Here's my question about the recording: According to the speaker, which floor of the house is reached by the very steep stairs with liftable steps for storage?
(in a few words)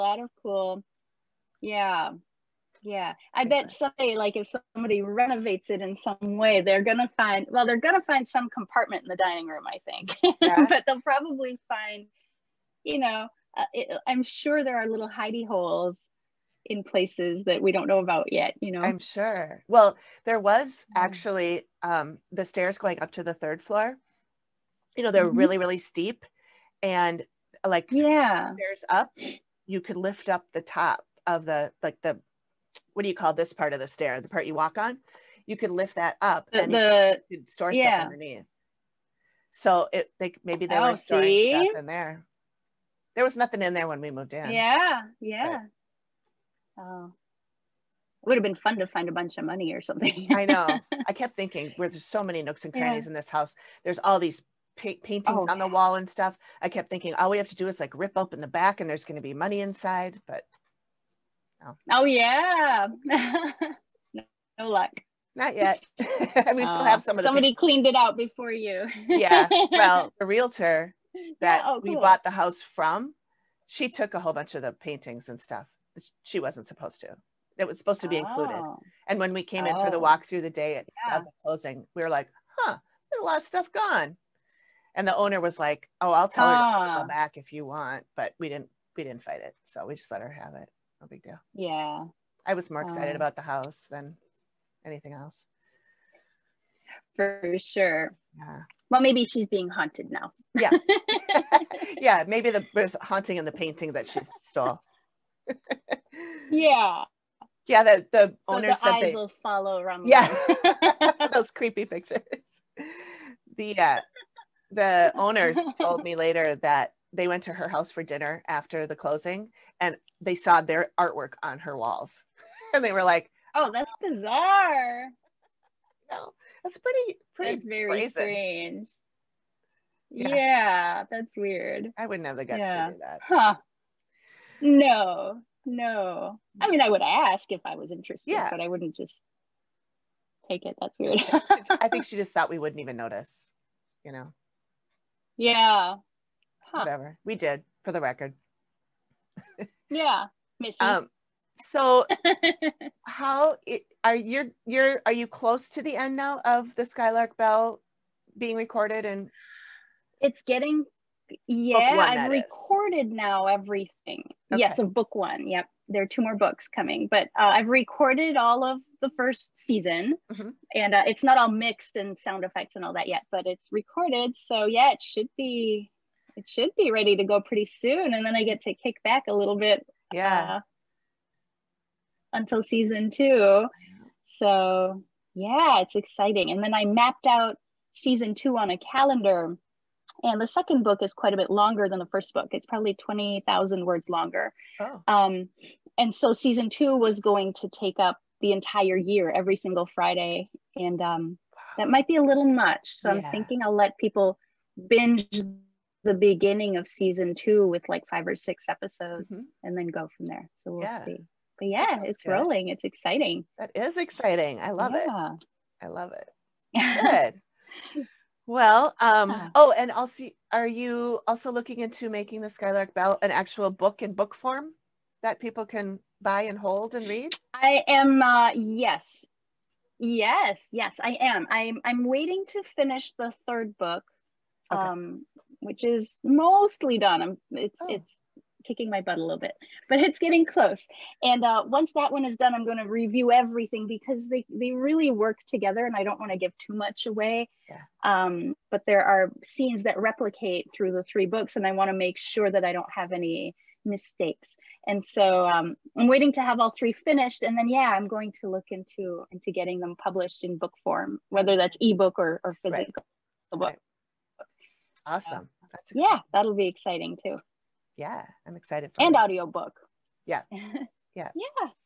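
third floor.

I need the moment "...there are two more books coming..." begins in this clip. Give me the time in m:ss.
2:45.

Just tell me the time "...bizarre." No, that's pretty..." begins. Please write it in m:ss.
2:04.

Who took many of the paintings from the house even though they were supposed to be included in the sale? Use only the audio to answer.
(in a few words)
the realtor.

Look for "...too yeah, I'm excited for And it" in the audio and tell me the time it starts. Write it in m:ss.
4:27.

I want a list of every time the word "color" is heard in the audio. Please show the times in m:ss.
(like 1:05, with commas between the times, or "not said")
not said.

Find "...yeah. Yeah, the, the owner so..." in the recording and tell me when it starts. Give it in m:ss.
1:46.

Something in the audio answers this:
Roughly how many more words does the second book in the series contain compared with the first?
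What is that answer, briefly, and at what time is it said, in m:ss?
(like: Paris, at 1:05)
20,000, at 3:12.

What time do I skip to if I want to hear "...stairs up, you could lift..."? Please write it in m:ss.
0:28.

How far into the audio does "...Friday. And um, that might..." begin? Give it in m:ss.
3:19.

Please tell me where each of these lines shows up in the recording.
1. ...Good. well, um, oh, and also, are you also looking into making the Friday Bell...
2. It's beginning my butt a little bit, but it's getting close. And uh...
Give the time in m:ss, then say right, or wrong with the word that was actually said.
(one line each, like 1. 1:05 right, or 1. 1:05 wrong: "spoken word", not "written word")
1. 3:37 wrong: "Skylark", not "Friday"
2. 3:57 wrong: "kicking", not "beginning".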